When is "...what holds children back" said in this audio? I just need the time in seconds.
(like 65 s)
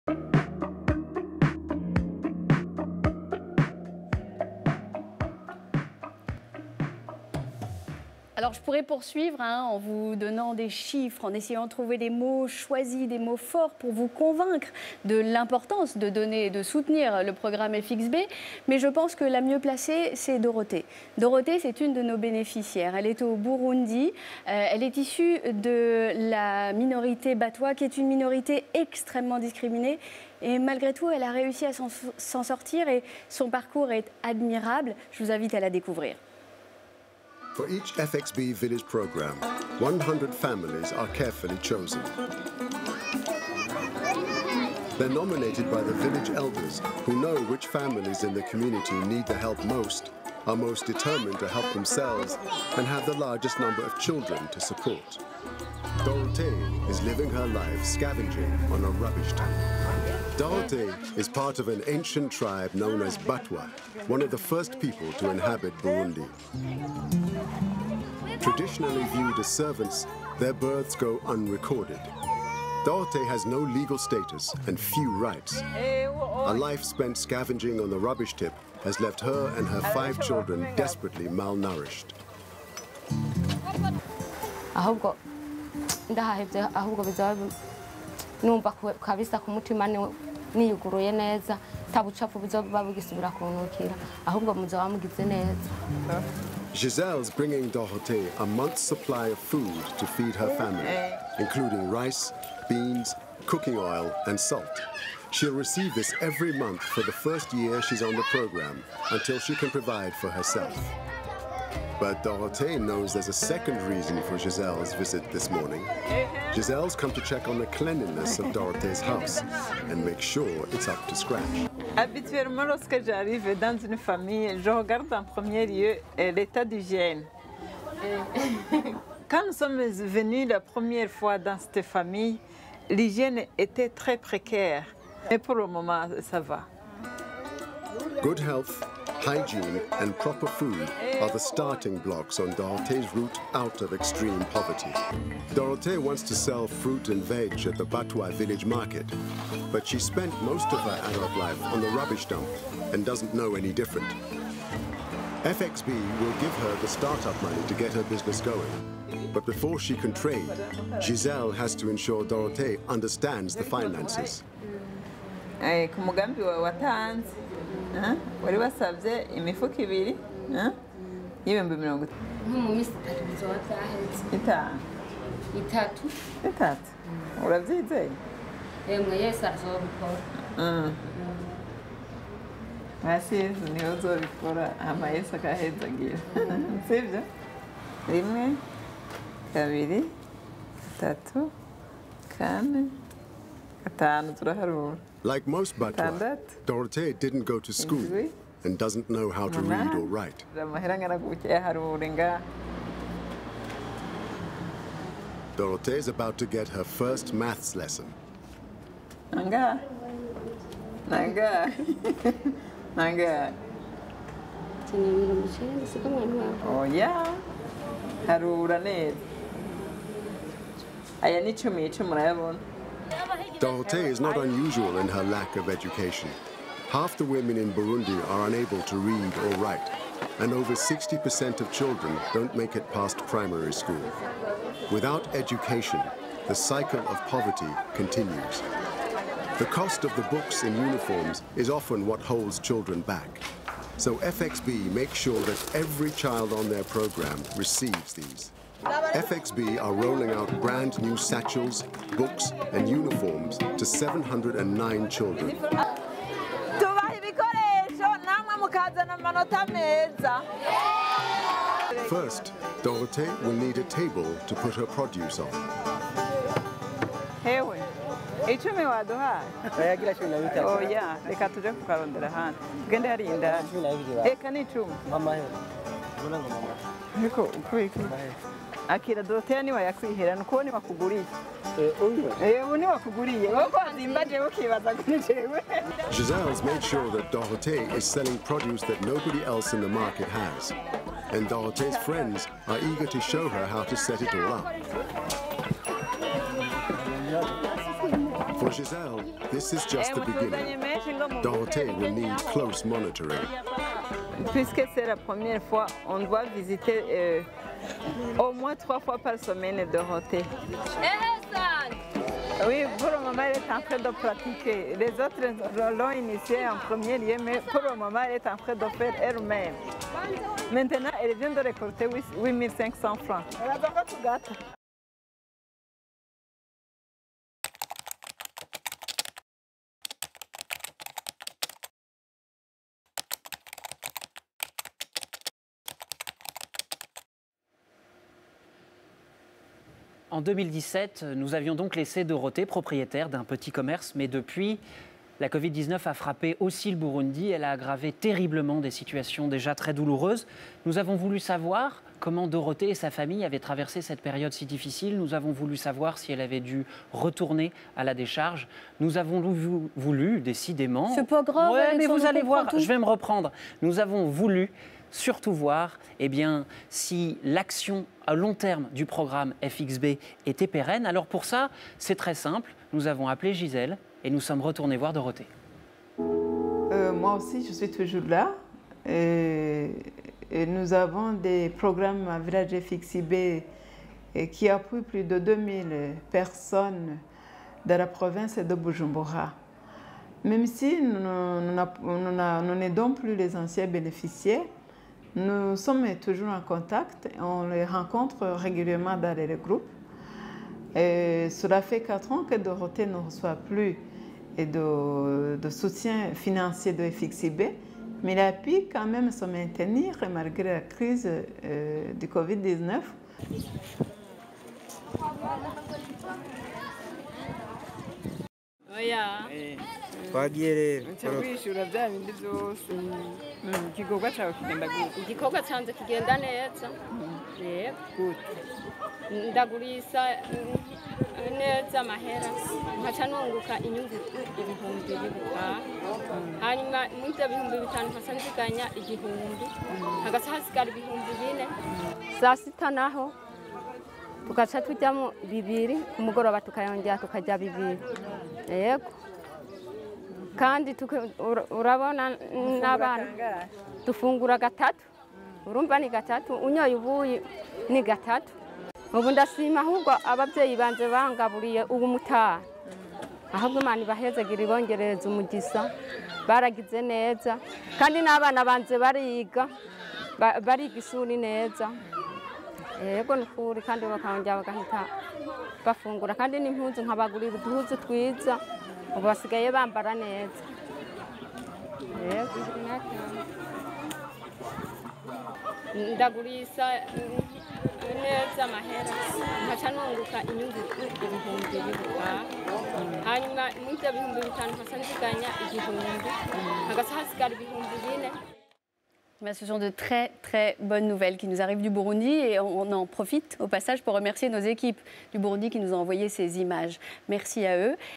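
242 s.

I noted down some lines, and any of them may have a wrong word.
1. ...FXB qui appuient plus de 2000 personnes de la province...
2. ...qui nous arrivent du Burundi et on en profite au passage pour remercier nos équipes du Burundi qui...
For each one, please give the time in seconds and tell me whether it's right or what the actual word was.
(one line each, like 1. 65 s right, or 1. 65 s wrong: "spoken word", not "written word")
1. 382 s right
2. 501 s right.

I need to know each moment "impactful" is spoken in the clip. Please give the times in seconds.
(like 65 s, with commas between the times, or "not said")
not said.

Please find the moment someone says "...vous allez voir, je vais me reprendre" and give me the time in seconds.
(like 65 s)
362 s.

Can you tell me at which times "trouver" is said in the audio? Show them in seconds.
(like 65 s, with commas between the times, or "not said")
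11 s.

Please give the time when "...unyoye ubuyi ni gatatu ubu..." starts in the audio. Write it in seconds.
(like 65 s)
456 s.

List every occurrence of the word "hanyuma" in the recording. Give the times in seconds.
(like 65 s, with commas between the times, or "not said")
436 s, 493 s.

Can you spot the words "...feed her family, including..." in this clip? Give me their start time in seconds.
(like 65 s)
100 s.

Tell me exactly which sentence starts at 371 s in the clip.
Alors pour ça, c'est très simple.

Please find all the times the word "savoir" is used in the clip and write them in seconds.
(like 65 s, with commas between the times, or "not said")
351 s, 355 s.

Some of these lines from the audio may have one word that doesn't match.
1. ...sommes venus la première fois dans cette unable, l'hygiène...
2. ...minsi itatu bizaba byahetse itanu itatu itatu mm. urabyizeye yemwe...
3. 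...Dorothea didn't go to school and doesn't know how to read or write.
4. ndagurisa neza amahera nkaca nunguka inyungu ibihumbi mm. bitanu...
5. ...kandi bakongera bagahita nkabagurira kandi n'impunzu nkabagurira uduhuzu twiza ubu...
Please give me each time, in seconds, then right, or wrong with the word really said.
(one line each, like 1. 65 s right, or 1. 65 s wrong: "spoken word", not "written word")
1. 129 s wrong: "famille", not "unable"
2. 172 s right
3. 196 s right
4. 429 s right
5. 473 s wrong: "bafungura", not "nkabagurira".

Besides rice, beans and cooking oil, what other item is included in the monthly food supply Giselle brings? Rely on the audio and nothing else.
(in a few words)
Salt.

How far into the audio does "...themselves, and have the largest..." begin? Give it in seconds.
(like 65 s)
51 s.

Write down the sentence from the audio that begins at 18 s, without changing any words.
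Mais je pense que la mieux placée, c'est Dorothée.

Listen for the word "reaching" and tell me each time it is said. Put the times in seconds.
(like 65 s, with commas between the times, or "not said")
not said.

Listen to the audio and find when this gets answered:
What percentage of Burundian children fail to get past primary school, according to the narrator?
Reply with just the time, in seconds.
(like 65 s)
230 s.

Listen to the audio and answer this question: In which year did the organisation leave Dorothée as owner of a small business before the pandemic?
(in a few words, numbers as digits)
2017.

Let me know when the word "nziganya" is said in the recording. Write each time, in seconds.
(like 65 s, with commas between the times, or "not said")
438 s, 495 s.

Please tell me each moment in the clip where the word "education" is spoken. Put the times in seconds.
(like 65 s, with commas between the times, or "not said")
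225 s, 235 s.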